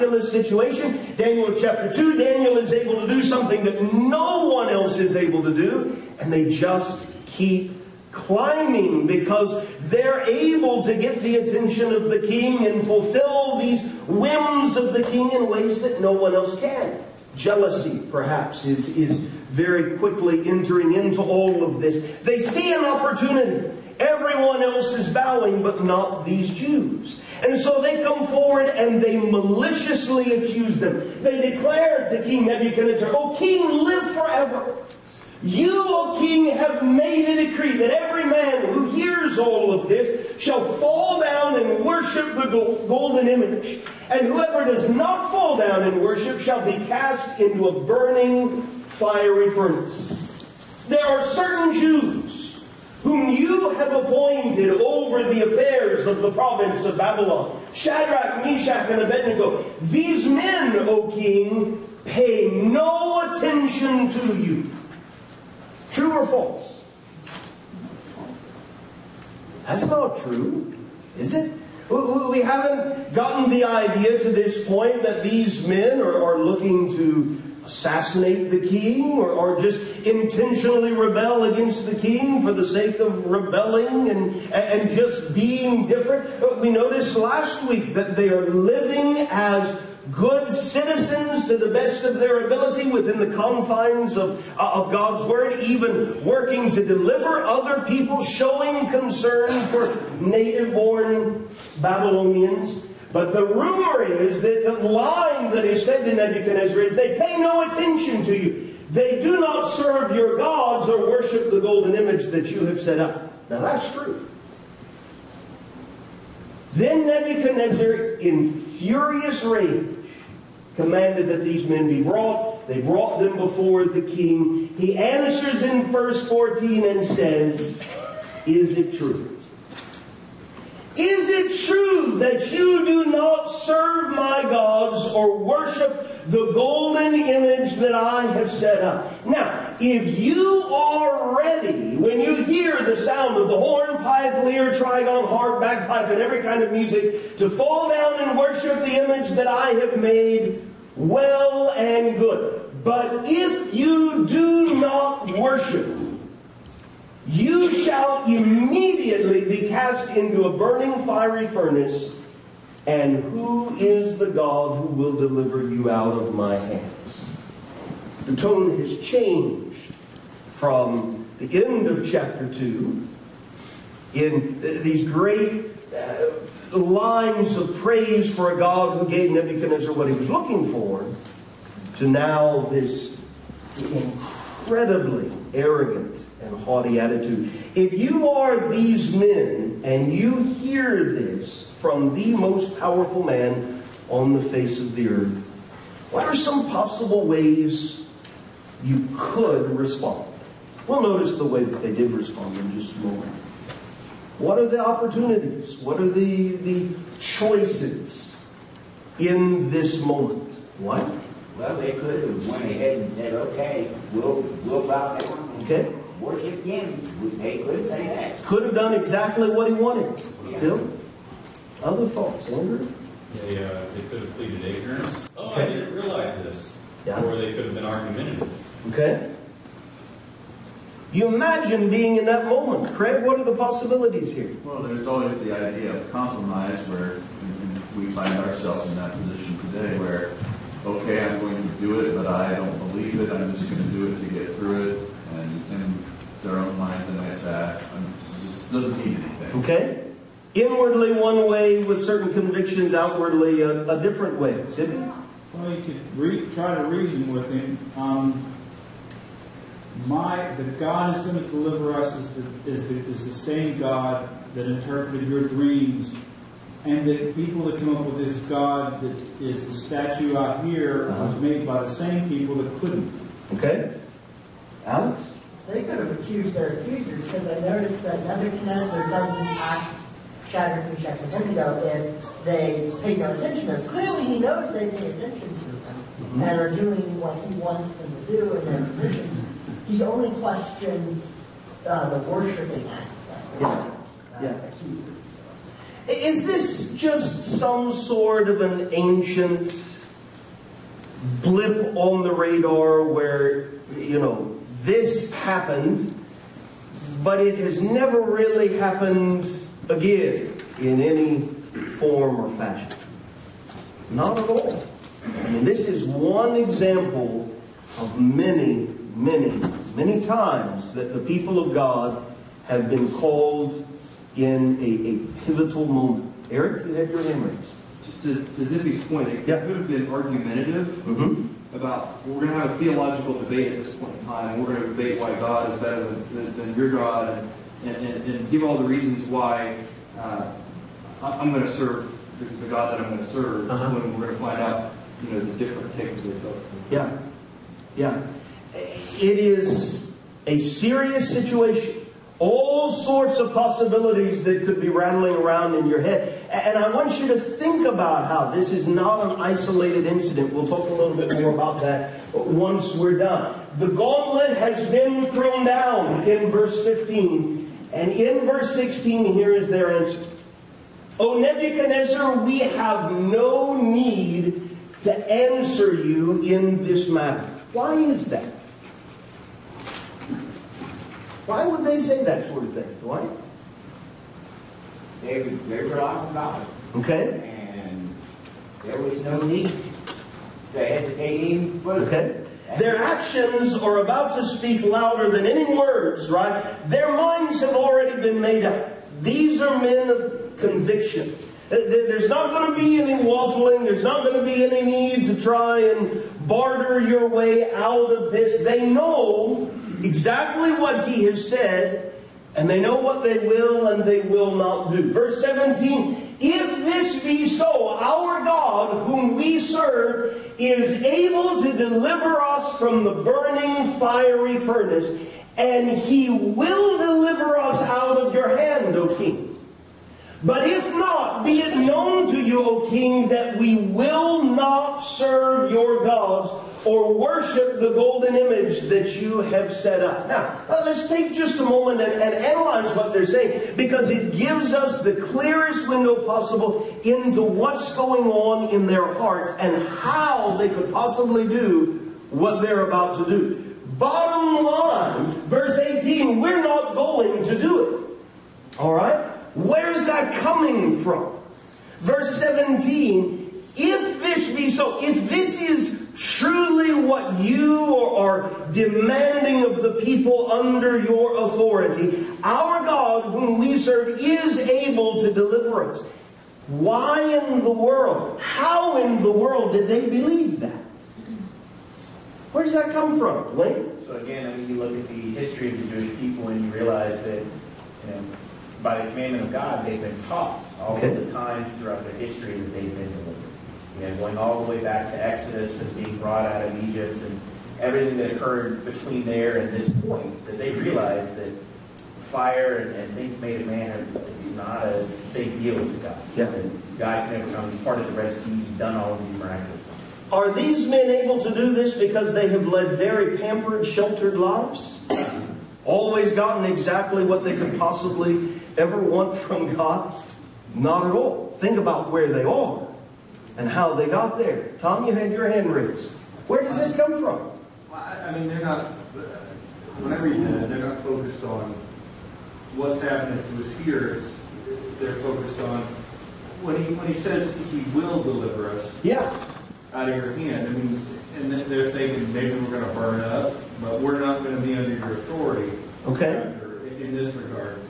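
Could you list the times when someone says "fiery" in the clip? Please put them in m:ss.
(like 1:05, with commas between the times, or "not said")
0:48, 2:41, 7:03.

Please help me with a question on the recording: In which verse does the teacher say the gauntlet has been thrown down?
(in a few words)
Verse 15.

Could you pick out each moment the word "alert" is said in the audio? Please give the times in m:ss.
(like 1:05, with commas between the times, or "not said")
not said.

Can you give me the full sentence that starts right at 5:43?
when we're going to find out you know the different takes of the Yeah, yeah.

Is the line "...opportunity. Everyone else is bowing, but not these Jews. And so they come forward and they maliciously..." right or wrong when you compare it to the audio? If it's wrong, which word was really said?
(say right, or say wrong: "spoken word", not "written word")
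right.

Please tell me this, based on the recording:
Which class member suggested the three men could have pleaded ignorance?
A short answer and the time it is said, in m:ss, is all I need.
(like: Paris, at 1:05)
Andrew, at 3:42.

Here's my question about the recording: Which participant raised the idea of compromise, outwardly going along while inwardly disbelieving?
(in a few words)
Craig.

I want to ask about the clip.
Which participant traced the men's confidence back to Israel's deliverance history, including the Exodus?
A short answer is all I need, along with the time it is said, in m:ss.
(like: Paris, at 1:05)
Link, at 8:03.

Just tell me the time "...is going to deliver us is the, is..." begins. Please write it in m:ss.
4:21.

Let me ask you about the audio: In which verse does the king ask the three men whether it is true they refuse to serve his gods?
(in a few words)
Verse 14.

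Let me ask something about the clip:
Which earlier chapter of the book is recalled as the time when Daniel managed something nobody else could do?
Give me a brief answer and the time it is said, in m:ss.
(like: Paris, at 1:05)
Chapter 2, at 0:01.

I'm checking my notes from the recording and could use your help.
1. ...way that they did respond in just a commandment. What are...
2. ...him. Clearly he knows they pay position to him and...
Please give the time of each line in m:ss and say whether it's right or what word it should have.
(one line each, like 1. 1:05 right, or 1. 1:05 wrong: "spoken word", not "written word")
1. 3:21 wrong: "moment", not "commandment"
2. 4:43 wrong: "attention", not "position".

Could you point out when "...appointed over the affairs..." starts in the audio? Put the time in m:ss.
0:53.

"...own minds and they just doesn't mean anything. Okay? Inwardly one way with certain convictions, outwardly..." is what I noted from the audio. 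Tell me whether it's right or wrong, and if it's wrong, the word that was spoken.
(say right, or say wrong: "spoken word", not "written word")
right.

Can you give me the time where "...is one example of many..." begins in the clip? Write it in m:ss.
5:15.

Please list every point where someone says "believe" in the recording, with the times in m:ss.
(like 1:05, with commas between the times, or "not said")
4:02, 8:00.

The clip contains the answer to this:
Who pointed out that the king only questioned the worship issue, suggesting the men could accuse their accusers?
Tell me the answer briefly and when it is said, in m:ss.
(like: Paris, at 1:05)
Alex, at 4:34.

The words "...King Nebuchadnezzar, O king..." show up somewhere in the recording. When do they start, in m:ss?
0:32.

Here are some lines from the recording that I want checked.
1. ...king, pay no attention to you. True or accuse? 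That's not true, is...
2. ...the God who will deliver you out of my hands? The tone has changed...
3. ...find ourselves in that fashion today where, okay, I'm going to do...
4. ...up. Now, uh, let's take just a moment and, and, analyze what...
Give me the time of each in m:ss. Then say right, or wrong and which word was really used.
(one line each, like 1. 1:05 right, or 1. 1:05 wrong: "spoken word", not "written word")
1. 1:01 wrong: "false", not "accuse"
2. 2:44 right
3. 3:58 wrong: "position", not "fashion"
4. 7:20 right.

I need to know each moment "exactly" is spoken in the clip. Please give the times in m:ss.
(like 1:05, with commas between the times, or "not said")
3:38, 6:50, 8:36.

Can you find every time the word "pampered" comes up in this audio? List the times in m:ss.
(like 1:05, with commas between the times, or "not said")
8:33.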